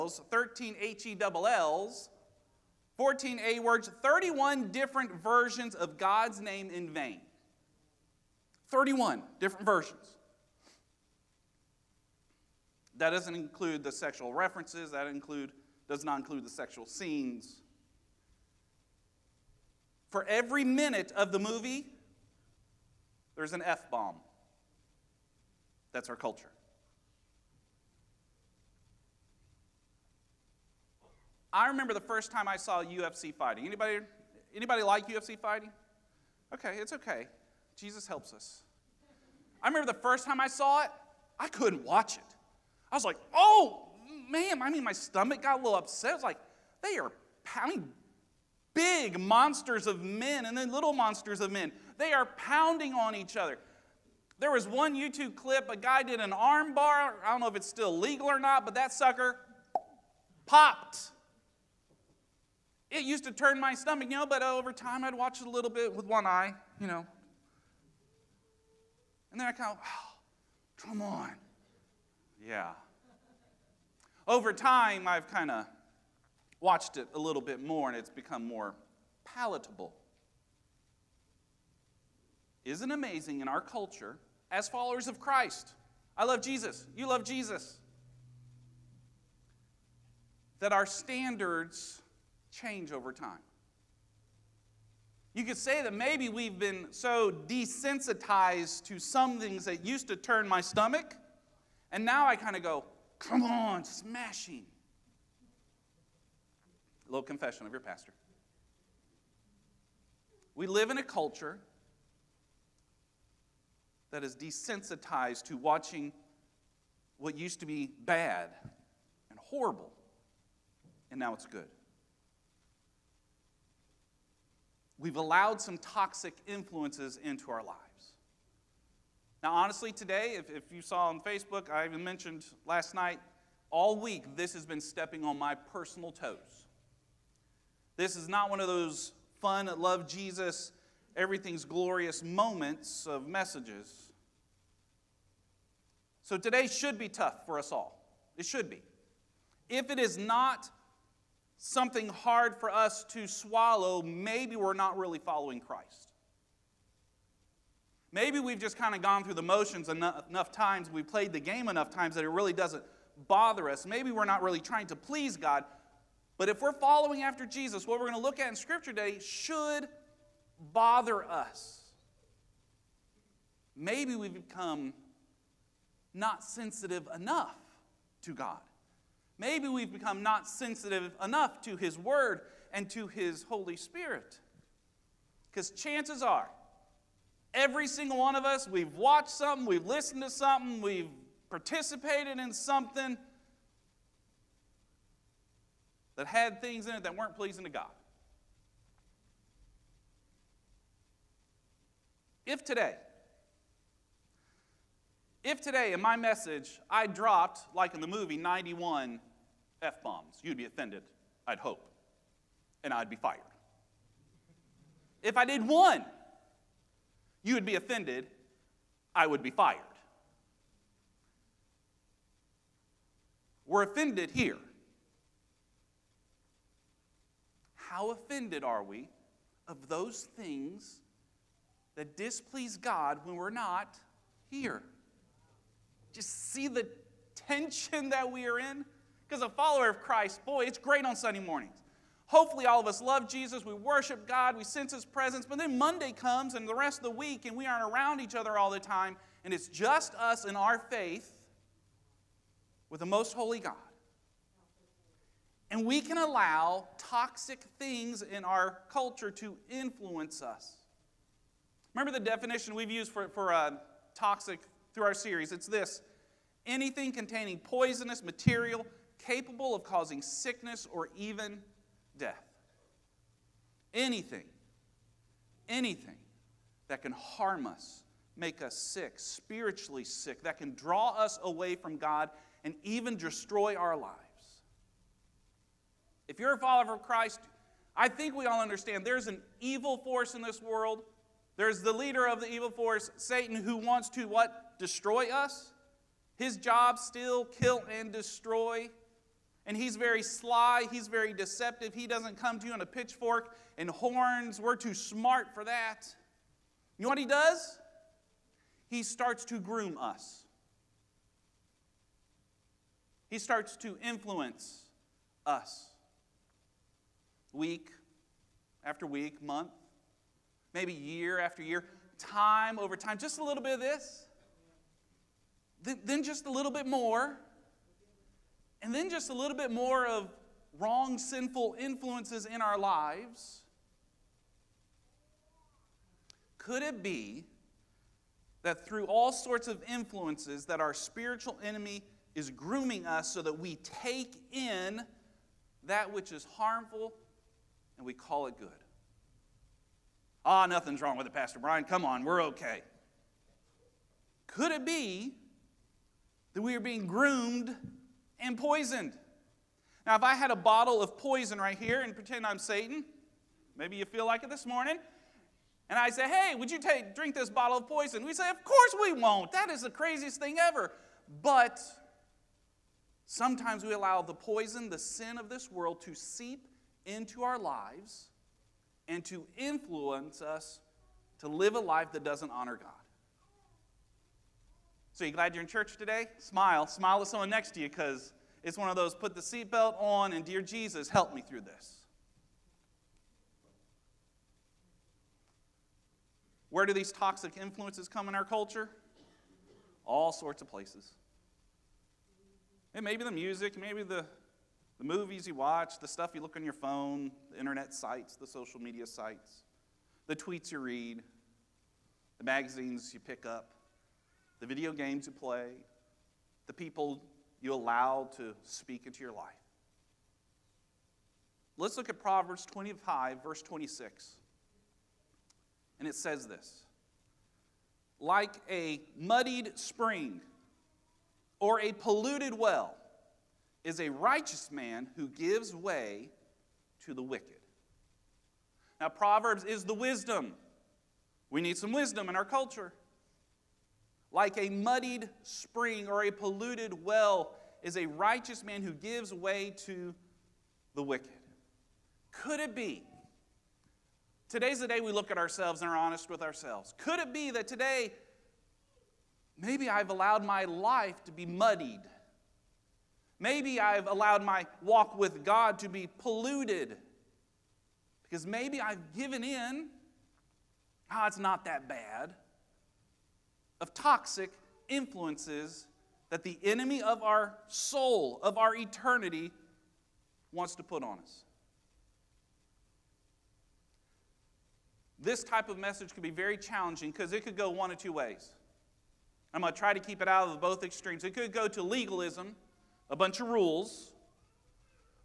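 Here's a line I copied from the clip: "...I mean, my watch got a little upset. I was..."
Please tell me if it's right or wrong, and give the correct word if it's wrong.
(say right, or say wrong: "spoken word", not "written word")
wrong: "stomach", not "watch".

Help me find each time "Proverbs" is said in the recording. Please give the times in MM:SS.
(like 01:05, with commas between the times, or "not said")
07:02, 07:19.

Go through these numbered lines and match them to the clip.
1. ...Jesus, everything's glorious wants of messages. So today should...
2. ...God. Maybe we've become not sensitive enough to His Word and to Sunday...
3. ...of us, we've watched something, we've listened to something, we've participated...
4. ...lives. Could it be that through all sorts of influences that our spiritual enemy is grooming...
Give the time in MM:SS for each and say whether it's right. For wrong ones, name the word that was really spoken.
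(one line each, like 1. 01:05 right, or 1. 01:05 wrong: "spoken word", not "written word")
1. 02:20 wrong: "moments", not "wants"
2. 02:58 wrong: "His", not "Sunday"
3. 03:08 right
4. 05:32 right.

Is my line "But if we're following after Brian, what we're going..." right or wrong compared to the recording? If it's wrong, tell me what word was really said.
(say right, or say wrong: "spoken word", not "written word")
wrong: "Jesus", not "Brian".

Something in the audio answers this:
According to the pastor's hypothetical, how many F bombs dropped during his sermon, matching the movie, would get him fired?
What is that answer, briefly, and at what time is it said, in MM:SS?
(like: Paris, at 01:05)
91, at 03:28.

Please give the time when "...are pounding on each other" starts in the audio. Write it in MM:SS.
00:52.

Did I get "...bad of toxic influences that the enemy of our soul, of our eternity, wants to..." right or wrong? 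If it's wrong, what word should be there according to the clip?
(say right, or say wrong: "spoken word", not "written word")
right.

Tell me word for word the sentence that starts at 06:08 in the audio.
We say, of course we won't.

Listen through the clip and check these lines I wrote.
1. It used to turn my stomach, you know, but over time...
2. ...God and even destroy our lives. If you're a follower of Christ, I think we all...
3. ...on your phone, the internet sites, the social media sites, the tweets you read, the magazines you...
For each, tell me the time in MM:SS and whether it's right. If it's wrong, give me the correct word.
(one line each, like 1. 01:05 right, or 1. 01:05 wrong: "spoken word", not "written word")
1. 01:02 right
2. 04:41 right
3. 06:46 right.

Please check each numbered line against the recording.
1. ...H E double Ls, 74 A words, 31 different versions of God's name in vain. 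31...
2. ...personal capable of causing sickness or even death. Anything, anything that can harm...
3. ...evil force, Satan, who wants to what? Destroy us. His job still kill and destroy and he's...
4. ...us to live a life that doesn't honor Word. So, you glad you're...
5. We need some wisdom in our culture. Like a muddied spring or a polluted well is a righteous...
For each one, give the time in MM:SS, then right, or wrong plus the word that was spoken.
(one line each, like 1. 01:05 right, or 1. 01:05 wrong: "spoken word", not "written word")
1. 00:00 wrong: "14", not "74"
2. 04:28 wrong: "material", not "personal"
3. 04:52 right
4. 06:20 wrong: "God", not "Word"
5. 07:21 right.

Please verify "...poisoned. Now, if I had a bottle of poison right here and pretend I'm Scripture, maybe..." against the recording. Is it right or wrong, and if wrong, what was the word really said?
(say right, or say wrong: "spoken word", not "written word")
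wrong: "Satan", not "Scripture".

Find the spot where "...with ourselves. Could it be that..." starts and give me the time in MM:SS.
07:36.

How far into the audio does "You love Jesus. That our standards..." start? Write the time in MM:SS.
01:26.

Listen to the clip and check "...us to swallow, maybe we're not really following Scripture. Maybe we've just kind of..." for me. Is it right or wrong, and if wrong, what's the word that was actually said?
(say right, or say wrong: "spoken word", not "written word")
wrong: "Christ", not "Scripture".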